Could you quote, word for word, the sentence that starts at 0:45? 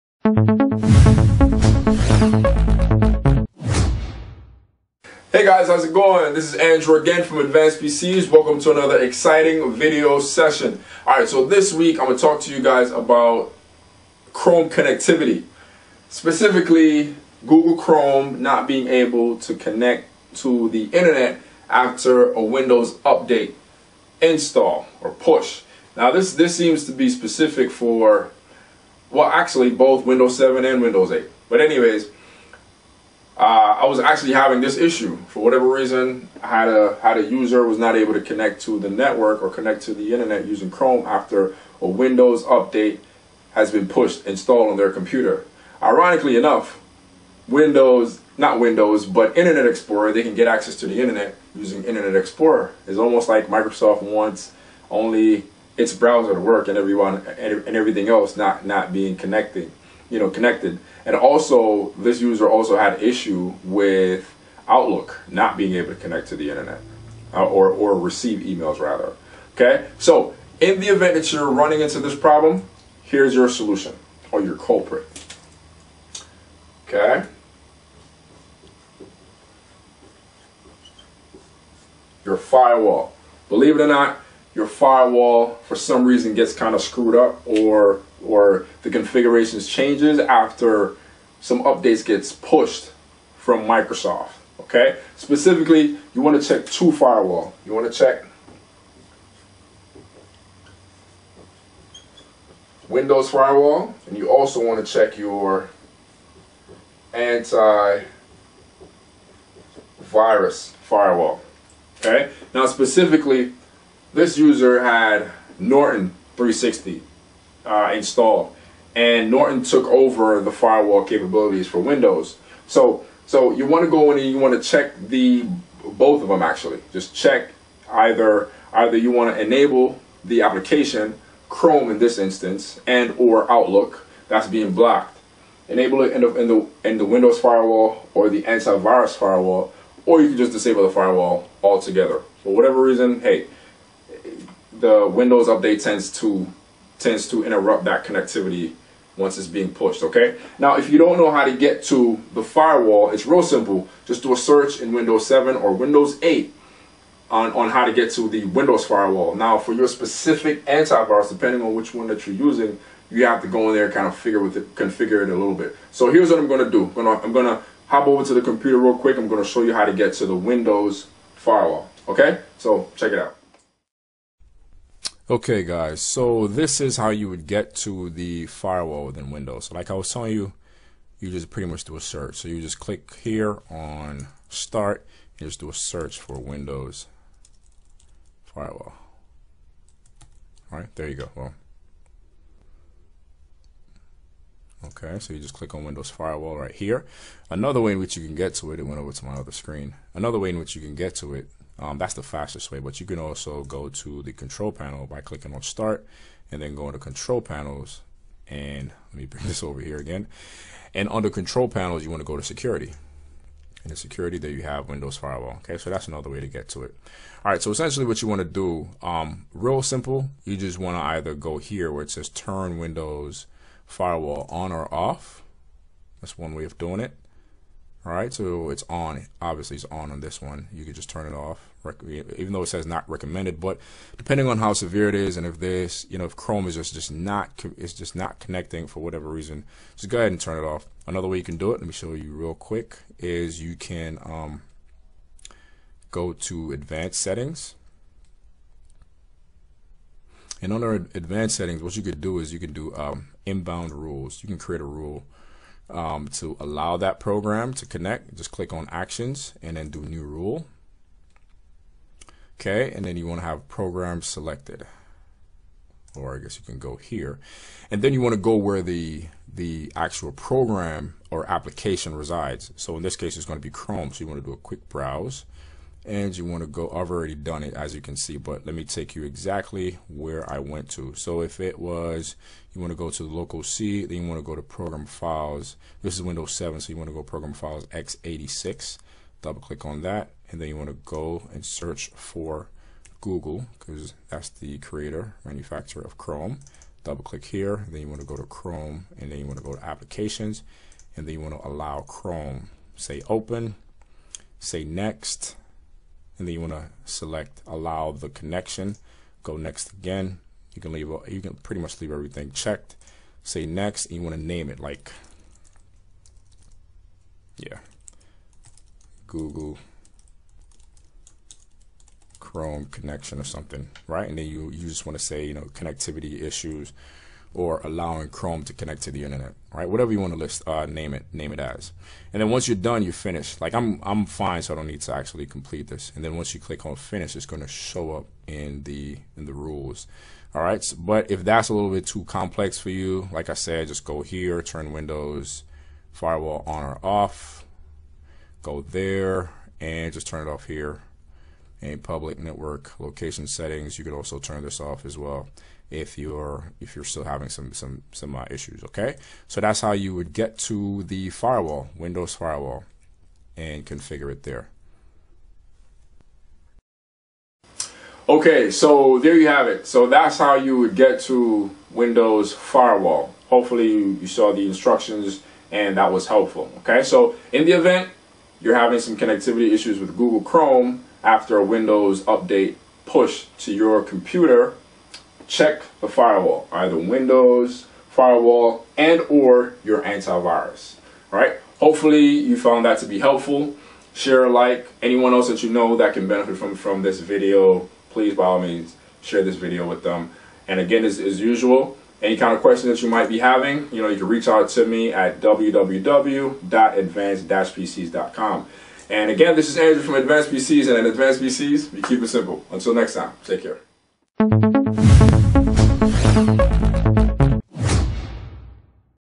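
Ironically enough, Windows, not Windows, but Internet Explorer, they can get access to the internet using Internet Explorer.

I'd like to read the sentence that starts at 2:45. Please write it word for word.
So here's what I'm gonna do.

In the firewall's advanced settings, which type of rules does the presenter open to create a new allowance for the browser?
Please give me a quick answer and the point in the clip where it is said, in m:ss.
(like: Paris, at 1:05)
Inbound rules, at 4:13.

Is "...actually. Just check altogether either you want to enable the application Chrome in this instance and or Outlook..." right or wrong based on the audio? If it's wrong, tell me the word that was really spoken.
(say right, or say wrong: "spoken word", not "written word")
wrong: "either", not "altogether".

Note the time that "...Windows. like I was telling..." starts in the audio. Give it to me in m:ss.
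2:59.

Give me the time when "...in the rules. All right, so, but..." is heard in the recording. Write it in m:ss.
5:39.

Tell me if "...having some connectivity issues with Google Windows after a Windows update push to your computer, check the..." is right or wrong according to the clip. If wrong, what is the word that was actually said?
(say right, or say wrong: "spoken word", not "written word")
wrong: "Chrome", not "Windows".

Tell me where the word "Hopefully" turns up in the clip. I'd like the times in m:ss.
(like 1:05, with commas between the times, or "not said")
6:13, 6:31.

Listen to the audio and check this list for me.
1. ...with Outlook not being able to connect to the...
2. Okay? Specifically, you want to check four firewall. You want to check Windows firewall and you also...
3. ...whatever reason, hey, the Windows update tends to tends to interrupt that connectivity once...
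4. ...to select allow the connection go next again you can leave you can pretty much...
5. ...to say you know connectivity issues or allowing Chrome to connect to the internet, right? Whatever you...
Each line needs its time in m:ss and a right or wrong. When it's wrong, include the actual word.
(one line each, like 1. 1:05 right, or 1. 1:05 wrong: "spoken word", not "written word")
1. 1:03 right
2. 1:34 wrong: "two", not "four"
3. 2:22 right
4. 5:06 right
5. 5:25 right.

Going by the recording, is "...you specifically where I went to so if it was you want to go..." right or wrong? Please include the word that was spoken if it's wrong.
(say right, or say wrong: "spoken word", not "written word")
wrong: "exactly", not "specifically".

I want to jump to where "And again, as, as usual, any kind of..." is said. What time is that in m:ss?
6:40.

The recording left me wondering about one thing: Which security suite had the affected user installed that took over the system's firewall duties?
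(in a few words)
Norton 360.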